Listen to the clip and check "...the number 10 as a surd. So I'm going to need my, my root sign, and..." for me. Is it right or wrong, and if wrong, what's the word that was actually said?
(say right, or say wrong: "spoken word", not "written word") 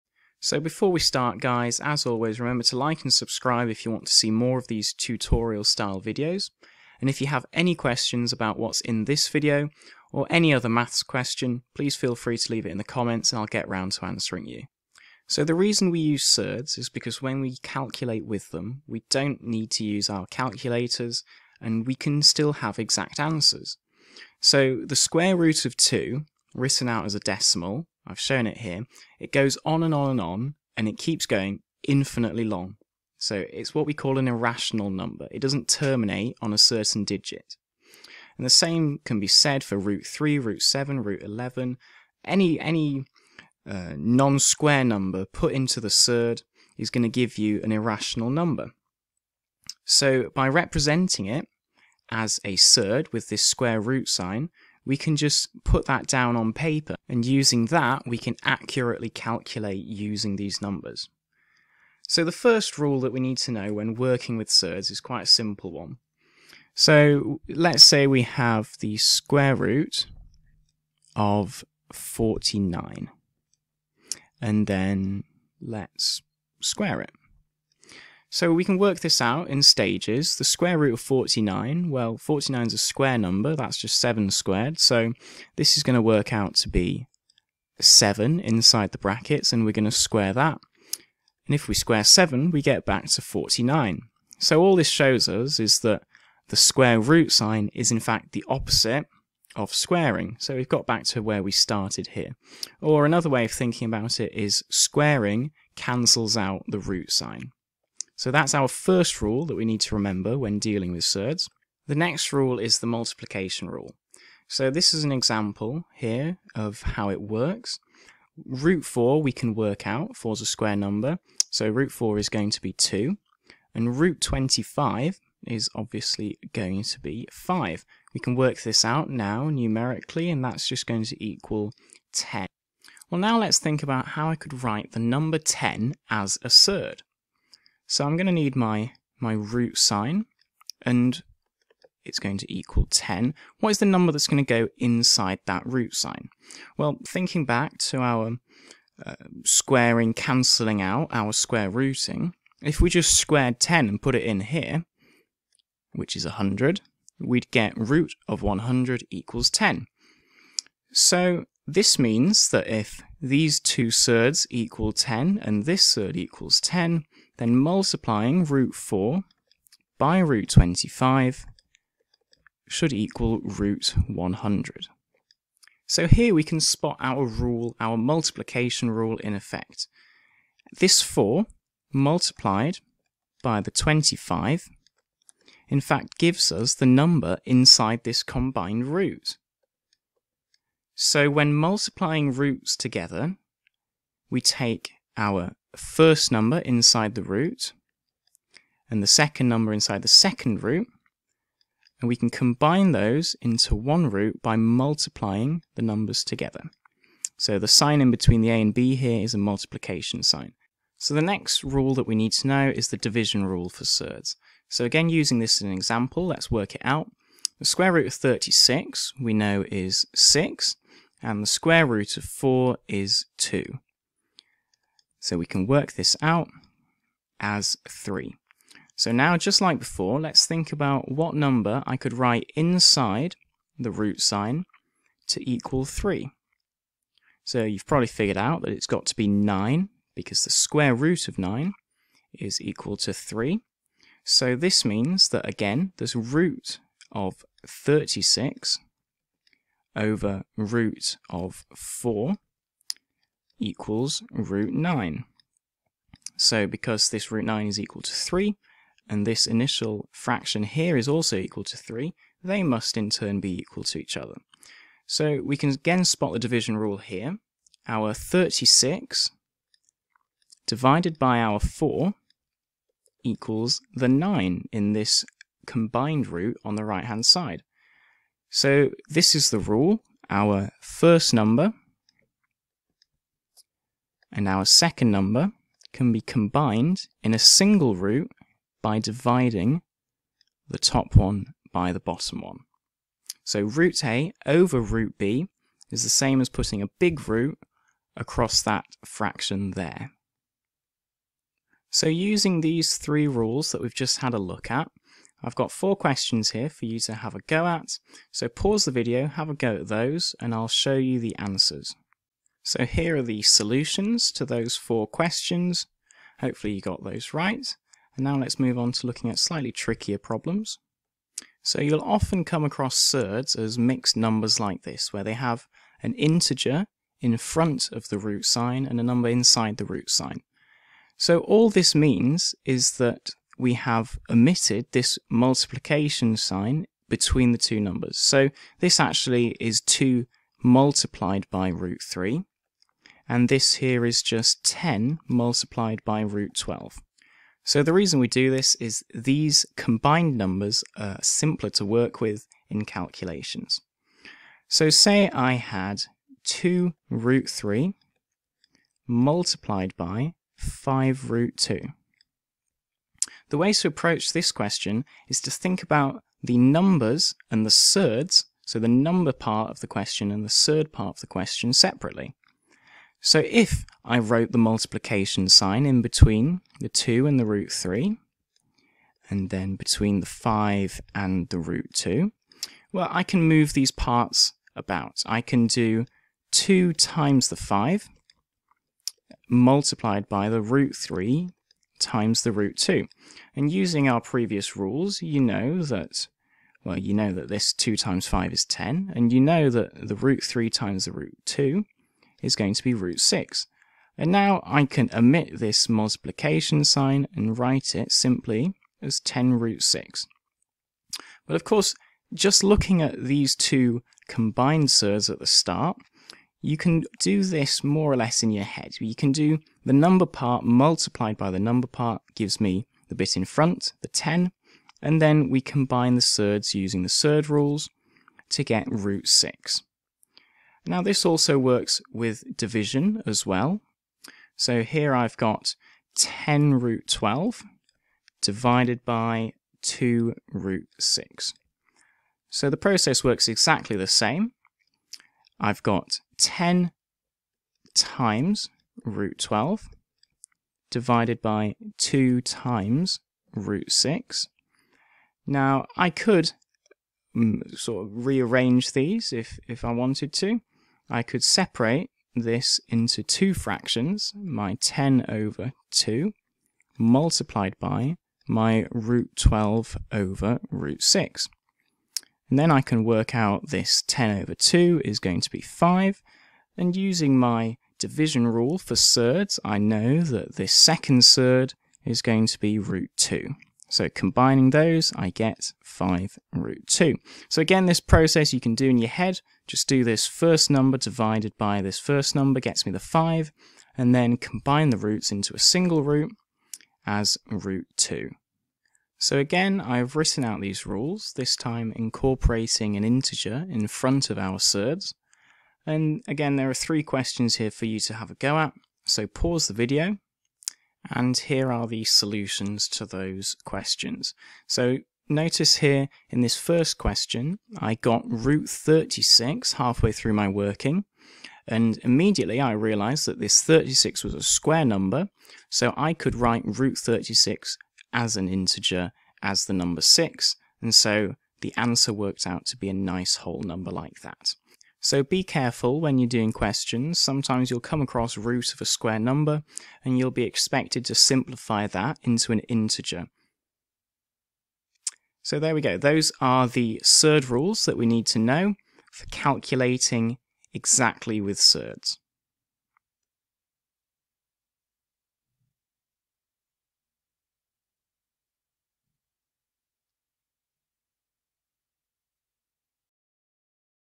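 right.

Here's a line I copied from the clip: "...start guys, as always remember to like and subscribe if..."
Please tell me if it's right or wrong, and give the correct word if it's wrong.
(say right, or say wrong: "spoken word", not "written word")
right.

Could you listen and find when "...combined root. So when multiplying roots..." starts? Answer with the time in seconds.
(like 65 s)
188 s.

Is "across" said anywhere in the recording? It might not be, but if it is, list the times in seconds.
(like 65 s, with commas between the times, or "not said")
298 s, 322 s, 538 s.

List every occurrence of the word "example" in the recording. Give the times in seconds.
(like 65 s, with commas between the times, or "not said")
115 s, 215 s.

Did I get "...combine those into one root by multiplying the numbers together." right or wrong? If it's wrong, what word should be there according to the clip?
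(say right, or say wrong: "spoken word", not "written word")
right.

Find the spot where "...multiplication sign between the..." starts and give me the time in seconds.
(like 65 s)
335 s.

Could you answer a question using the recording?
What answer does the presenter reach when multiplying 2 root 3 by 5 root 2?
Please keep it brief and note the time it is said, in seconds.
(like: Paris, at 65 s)
10 root 6, at 409 s.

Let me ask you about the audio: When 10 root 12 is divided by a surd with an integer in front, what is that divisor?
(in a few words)
2 root 6.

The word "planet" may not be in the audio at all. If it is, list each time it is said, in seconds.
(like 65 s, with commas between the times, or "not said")
not said.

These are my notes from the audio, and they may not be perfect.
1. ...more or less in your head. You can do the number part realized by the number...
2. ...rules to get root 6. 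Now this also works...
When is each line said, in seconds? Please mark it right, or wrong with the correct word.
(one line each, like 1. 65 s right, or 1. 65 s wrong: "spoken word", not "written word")
1. 417 s wrong: "multiplied", not "realized"
2. 427 s right.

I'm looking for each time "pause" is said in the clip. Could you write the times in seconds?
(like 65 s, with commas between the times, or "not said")
308 s, 509 s.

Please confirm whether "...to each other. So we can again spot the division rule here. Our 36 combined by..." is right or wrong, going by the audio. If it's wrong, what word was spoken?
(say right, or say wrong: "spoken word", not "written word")
wrong: "divided", not "combined".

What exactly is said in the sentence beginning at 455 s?
Now I could mm, sort of rearrange these if, if I wanted to.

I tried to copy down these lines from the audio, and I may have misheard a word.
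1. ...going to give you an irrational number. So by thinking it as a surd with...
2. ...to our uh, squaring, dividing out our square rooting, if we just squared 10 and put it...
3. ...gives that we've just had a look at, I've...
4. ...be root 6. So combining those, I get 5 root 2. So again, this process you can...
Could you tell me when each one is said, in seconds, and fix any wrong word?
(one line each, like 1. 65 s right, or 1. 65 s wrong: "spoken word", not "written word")
1. 46 s wrong: "representing", not "thinking"
2. 147 s wrong: "cancelling", not "dividing"
3. 303 s wrong: "rules", not "gives"
4. 482 s wrong: "2", not "6".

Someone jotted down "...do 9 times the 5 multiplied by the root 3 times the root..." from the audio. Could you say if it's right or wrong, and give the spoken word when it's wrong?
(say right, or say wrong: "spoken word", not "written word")
wrong: "2", not "9".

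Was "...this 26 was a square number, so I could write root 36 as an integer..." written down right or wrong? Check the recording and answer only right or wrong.
wrong.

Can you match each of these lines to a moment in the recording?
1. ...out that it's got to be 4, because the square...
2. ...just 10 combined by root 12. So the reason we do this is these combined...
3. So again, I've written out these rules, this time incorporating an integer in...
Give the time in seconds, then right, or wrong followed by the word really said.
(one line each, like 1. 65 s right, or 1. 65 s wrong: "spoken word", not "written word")
1. 238 s wrong: "9", not "4"
2. 344 s wrong: "multiplied", not "combined"
3. 499 s right.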